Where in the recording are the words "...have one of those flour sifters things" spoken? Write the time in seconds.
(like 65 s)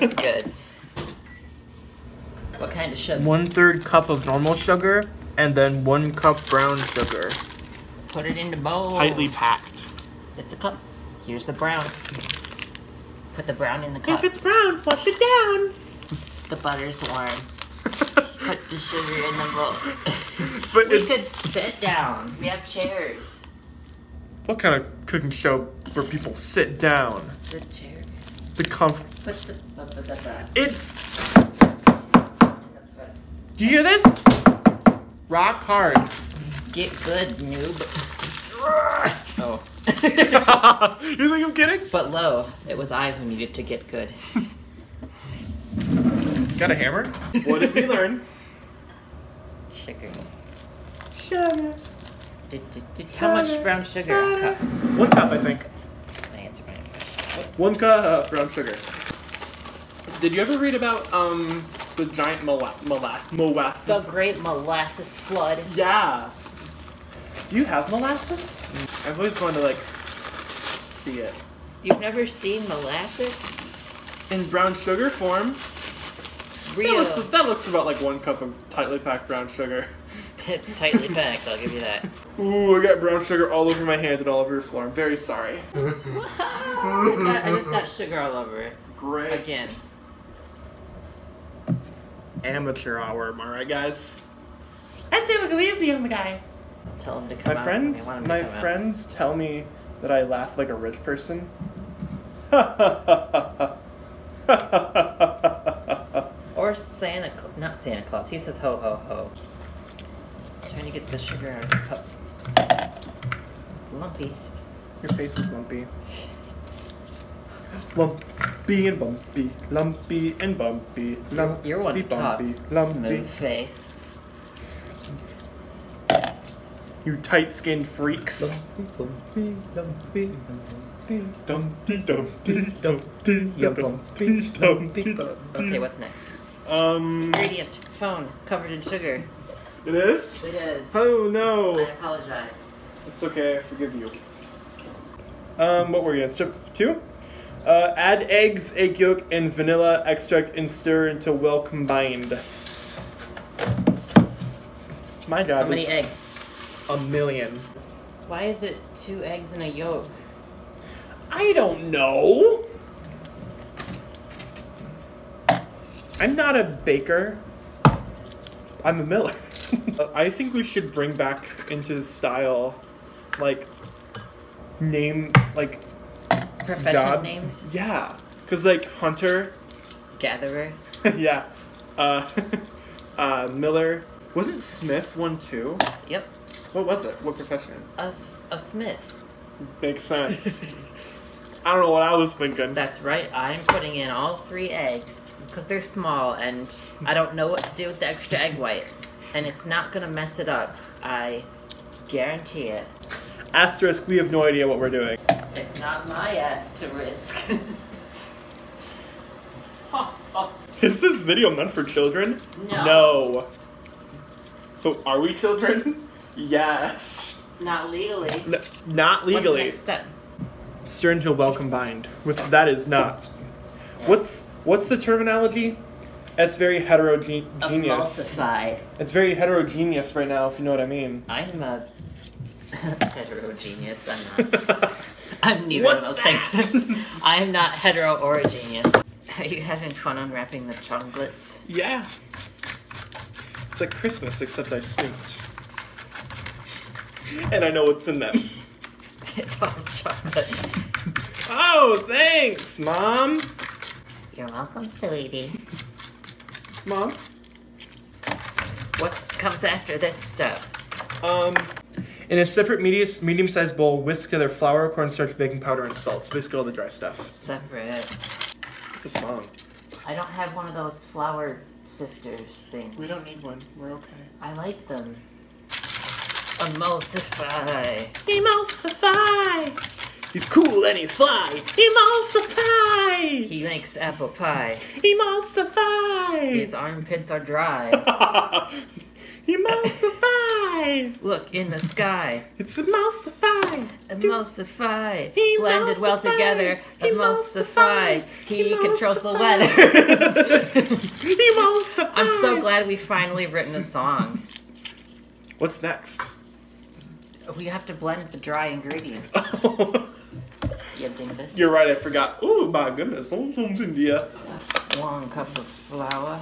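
270 s.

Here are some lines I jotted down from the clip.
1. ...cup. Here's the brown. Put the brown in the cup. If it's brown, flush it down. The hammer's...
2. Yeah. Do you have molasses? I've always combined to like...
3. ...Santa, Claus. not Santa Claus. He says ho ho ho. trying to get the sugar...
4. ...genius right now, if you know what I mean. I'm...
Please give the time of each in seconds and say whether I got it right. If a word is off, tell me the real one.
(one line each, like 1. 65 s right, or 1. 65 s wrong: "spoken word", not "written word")
1. 10 s wrong: "butter", not "hammer"
2. 65 s wrong: "wanted", not "combined"
3. 106 s right
4. 229 s wrong: "heterogeneous", not "genius".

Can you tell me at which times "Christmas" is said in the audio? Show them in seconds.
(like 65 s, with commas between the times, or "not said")
243 s.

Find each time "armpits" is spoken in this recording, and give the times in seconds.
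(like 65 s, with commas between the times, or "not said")
286 s.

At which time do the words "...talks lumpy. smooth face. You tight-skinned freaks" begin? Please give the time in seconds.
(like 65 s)
122 s.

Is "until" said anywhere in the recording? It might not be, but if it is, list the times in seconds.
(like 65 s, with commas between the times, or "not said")
151 s, 221 s.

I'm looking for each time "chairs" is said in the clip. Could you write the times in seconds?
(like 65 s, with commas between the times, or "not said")
22 s, 27 s.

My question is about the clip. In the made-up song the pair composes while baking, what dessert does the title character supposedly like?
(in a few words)
Apple pie.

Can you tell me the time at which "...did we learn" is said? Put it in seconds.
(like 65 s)
47 s.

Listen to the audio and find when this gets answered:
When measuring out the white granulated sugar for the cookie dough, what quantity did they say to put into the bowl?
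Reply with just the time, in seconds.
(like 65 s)
3 s.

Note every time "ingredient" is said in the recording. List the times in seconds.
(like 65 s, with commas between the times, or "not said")
137 s, 308 s.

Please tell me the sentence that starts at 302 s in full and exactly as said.
I'm so glad we finally written a song.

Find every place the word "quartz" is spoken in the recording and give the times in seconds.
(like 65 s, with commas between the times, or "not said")
not said.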